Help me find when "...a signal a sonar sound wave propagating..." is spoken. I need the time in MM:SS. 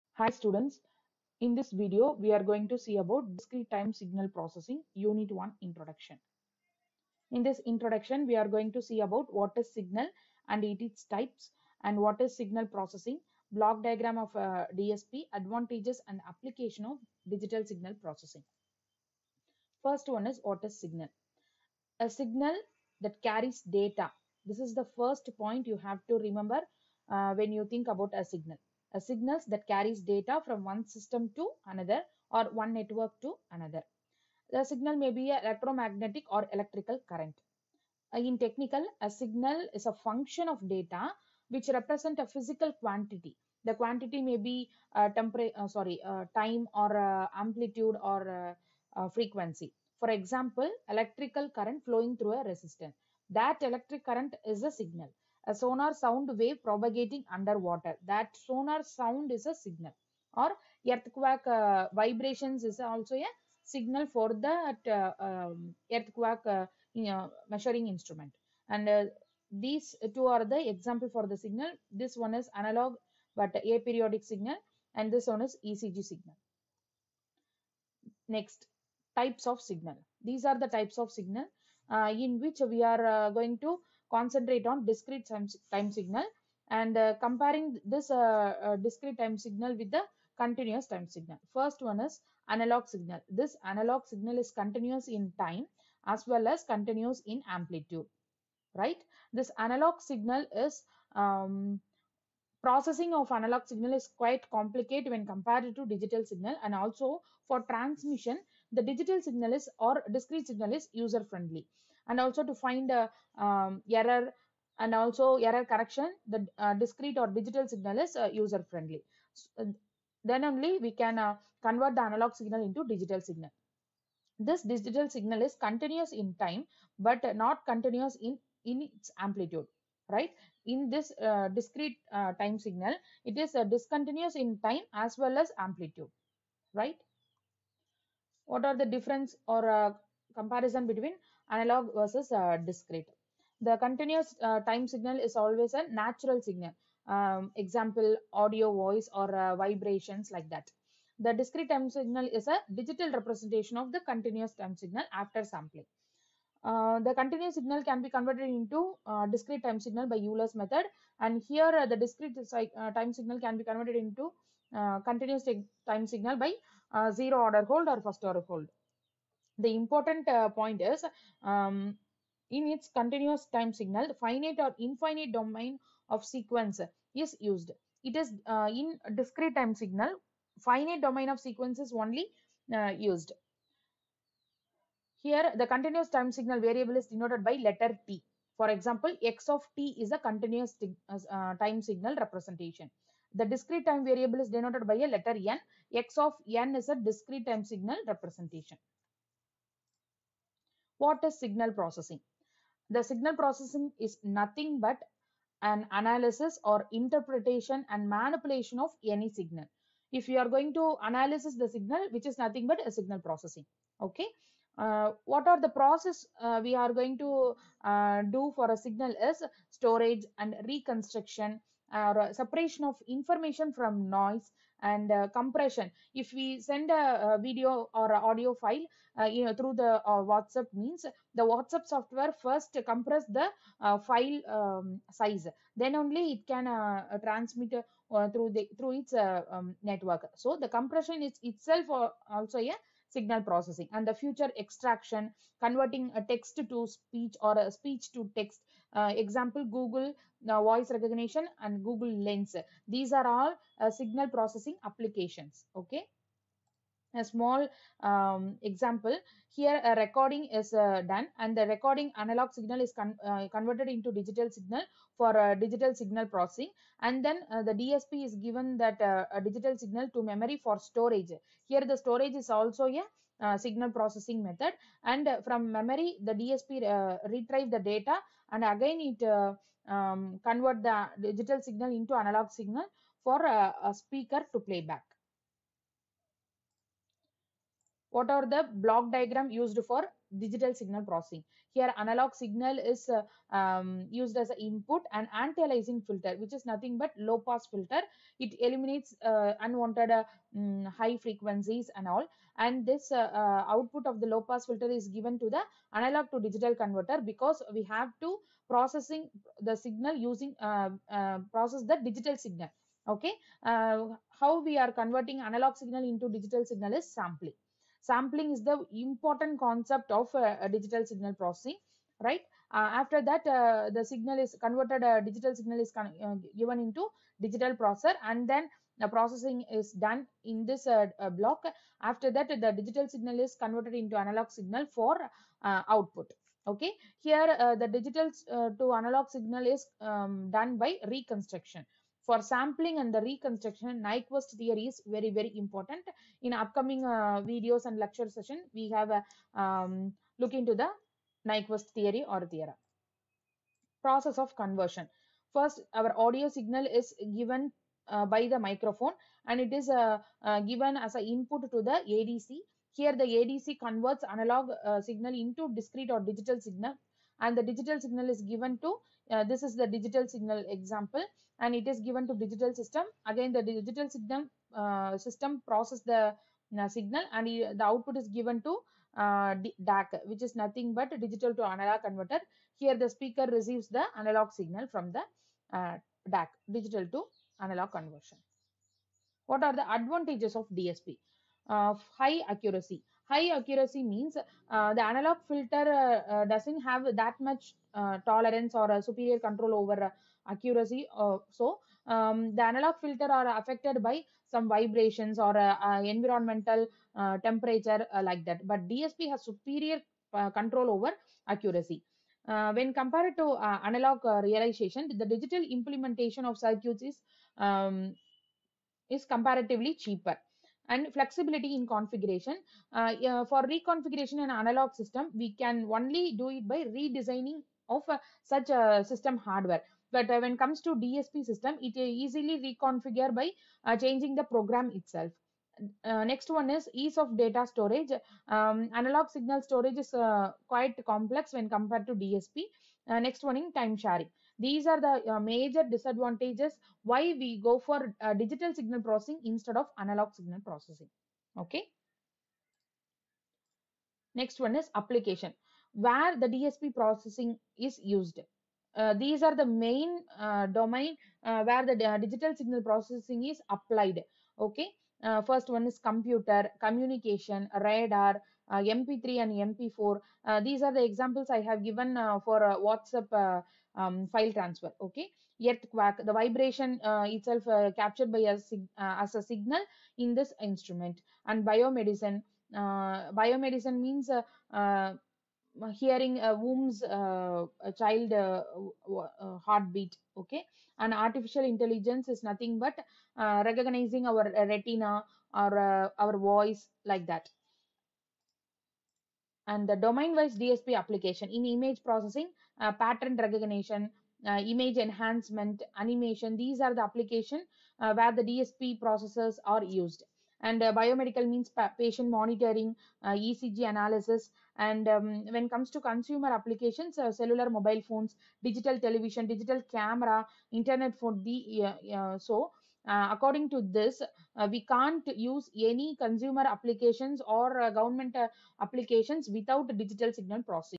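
00:54.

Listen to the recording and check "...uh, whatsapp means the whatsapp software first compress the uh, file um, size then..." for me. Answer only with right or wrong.
right.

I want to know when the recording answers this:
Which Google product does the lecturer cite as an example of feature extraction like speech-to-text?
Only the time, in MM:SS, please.
04:11.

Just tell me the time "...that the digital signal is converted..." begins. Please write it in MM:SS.
05:32.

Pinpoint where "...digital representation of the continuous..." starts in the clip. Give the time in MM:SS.
02:32.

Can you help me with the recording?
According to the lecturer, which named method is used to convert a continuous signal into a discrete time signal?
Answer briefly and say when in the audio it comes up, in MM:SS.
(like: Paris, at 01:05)
Euler's method, at 02:40.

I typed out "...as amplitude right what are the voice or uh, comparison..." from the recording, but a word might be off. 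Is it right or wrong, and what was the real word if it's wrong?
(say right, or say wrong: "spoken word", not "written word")
wrong: "difference", not "voice".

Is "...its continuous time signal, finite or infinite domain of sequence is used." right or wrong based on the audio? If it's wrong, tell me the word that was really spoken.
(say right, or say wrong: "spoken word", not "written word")
right.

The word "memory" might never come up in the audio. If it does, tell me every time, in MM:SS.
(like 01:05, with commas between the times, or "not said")
04:30, 04:35.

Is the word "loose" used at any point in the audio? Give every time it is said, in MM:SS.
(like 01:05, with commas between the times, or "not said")
not said.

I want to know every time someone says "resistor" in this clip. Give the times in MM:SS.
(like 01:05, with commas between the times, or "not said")
00:52.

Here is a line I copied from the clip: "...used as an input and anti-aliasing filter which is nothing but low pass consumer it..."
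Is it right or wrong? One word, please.
wrong.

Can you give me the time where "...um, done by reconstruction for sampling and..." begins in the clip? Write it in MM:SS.
05:40.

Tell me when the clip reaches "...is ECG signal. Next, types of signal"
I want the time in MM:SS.
01:15.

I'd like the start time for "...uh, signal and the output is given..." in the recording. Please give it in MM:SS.
06:16.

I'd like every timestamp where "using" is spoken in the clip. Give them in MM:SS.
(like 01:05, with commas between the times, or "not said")
05:10.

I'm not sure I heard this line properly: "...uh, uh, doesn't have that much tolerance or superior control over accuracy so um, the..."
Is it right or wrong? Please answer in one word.
right.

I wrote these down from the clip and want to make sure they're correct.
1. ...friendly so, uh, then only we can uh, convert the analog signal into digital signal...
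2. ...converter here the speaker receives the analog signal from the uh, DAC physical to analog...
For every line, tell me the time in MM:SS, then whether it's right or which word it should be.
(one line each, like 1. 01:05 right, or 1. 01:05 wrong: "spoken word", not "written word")
1. 01:58 right
2. 06:22 wrong: "digital", not "physical".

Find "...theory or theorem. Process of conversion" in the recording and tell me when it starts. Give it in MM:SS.
05:51.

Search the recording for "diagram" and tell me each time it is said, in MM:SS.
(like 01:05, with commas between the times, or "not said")
00:13, 04:49.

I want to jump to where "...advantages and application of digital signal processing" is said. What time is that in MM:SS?
00:15.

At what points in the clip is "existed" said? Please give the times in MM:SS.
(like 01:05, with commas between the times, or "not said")
not said.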